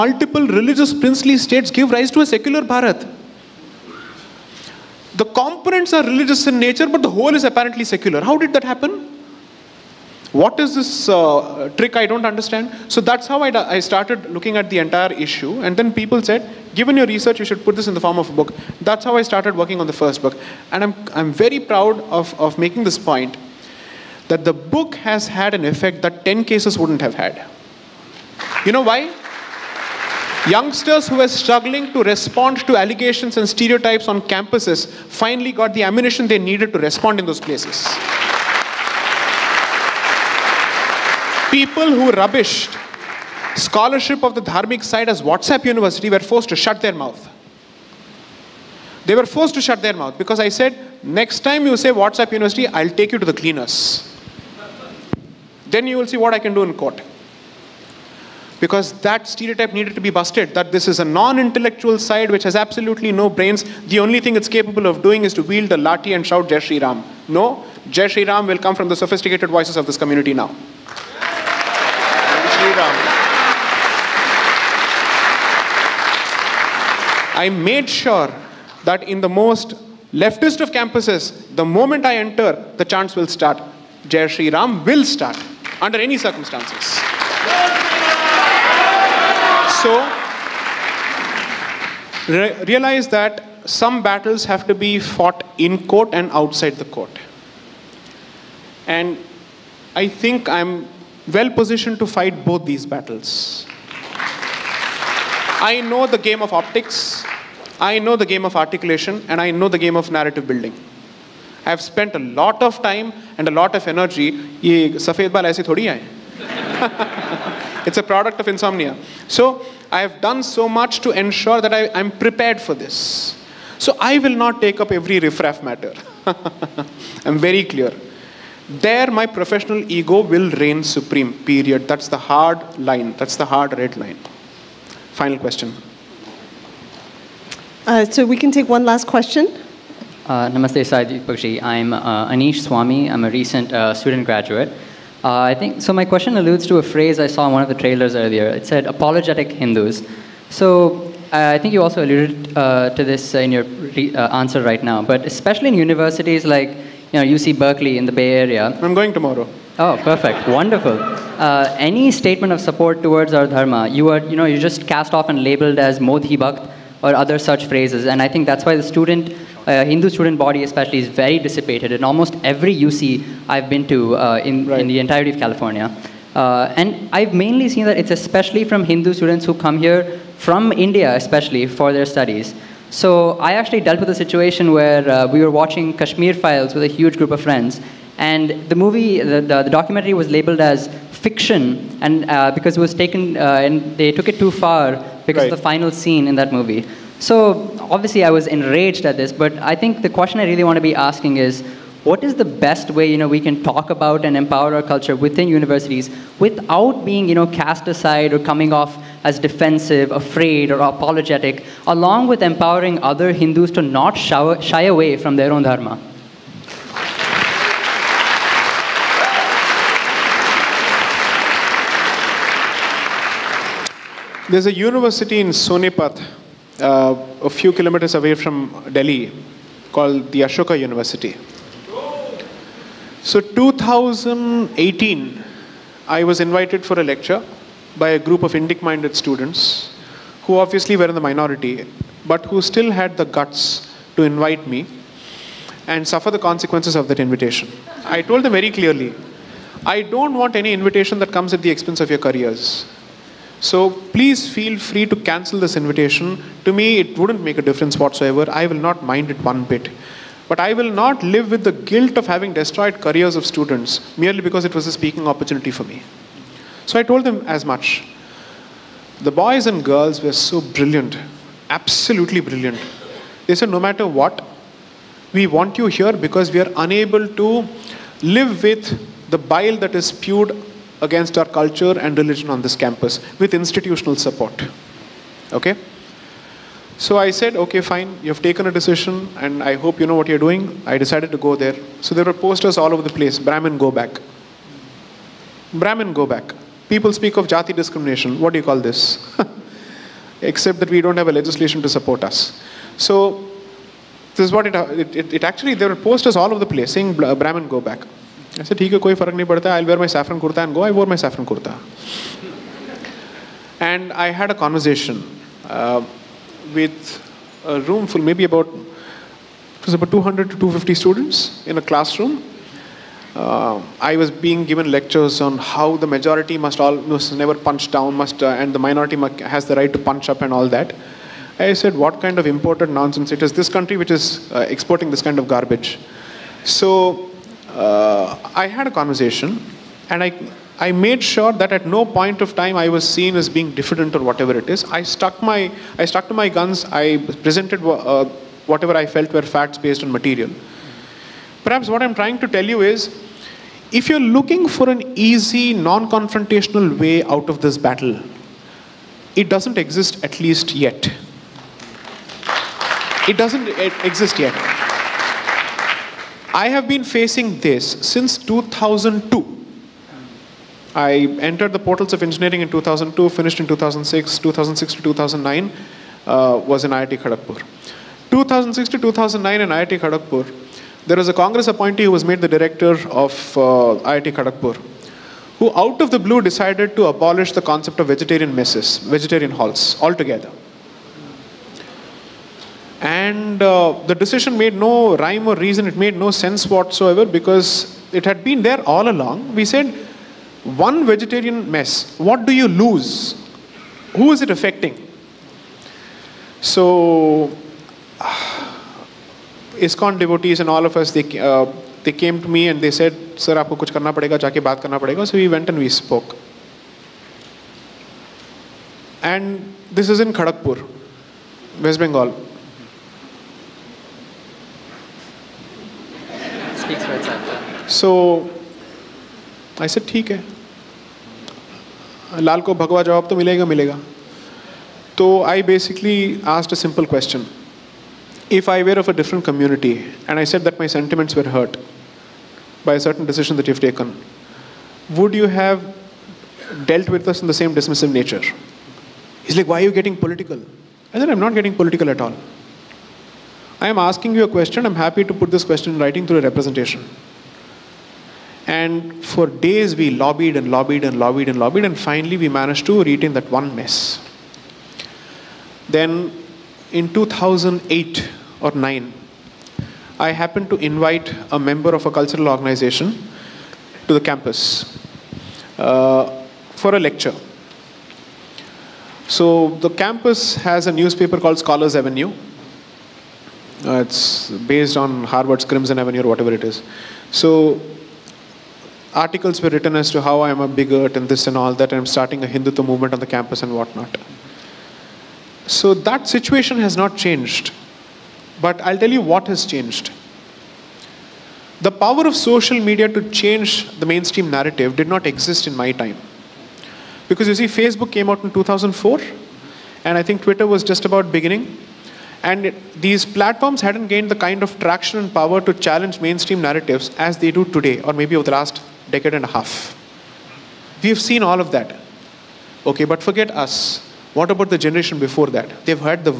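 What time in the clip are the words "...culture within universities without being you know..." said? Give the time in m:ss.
3:24.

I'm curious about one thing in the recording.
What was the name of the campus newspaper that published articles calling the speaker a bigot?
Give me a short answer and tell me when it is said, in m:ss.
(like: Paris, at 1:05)
Scholars Avenue, at 8:01.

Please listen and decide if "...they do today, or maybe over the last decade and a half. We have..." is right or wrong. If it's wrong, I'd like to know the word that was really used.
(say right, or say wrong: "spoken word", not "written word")
right.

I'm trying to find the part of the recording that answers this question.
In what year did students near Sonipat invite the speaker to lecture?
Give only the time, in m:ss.
3:53.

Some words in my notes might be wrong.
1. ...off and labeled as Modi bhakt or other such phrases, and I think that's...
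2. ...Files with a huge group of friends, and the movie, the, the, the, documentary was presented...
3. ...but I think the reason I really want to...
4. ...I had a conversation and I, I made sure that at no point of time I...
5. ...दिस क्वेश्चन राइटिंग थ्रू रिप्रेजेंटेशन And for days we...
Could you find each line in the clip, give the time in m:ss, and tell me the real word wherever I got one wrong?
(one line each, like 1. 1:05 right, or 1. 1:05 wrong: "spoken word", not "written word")
1. 2:45 right
2. 3:06 wrong: "labeled", not "presented"
3. 3:19 wrong: "question", not "reason"
4. 5:38 right
5. 7:35 right.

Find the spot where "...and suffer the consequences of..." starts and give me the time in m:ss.
4:05.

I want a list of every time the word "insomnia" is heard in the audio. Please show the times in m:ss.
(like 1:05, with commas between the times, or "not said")
1:58.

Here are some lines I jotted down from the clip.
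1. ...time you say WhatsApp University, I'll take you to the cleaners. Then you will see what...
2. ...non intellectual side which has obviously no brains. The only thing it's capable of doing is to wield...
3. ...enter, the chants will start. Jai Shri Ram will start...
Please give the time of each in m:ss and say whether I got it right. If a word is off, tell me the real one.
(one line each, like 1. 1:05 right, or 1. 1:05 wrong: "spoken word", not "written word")
1. 0:51 right
2. 1:01 wrong: "absolutely", not "obviously"
3. 1:22 right.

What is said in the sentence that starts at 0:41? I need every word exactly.
People who rubbished scholarship of the Dharmic side as WhatsApp University were forced to shut their mouth.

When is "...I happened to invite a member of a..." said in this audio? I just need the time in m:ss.
7:50.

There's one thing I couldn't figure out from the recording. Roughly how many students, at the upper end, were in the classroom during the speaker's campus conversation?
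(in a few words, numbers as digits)
250.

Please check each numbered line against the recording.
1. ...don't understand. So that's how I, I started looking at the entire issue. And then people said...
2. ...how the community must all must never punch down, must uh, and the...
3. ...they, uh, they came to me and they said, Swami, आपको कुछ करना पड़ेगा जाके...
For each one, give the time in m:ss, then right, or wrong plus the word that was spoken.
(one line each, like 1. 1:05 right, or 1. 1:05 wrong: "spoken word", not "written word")
1. 0:12 right
2. 5:25 wrong: "majority", not "community"
3. 6:51 wrong: "Sir", not "Swami".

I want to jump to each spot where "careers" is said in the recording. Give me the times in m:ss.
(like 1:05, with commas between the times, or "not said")
4:12, 4:23.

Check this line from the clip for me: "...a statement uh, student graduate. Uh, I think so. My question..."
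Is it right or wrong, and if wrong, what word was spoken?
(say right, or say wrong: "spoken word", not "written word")
wrong: "recent", not "statement".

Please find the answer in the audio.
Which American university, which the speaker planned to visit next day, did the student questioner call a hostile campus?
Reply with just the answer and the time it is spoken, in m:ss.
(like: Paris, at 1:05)
UC Berkeley, at 2:37.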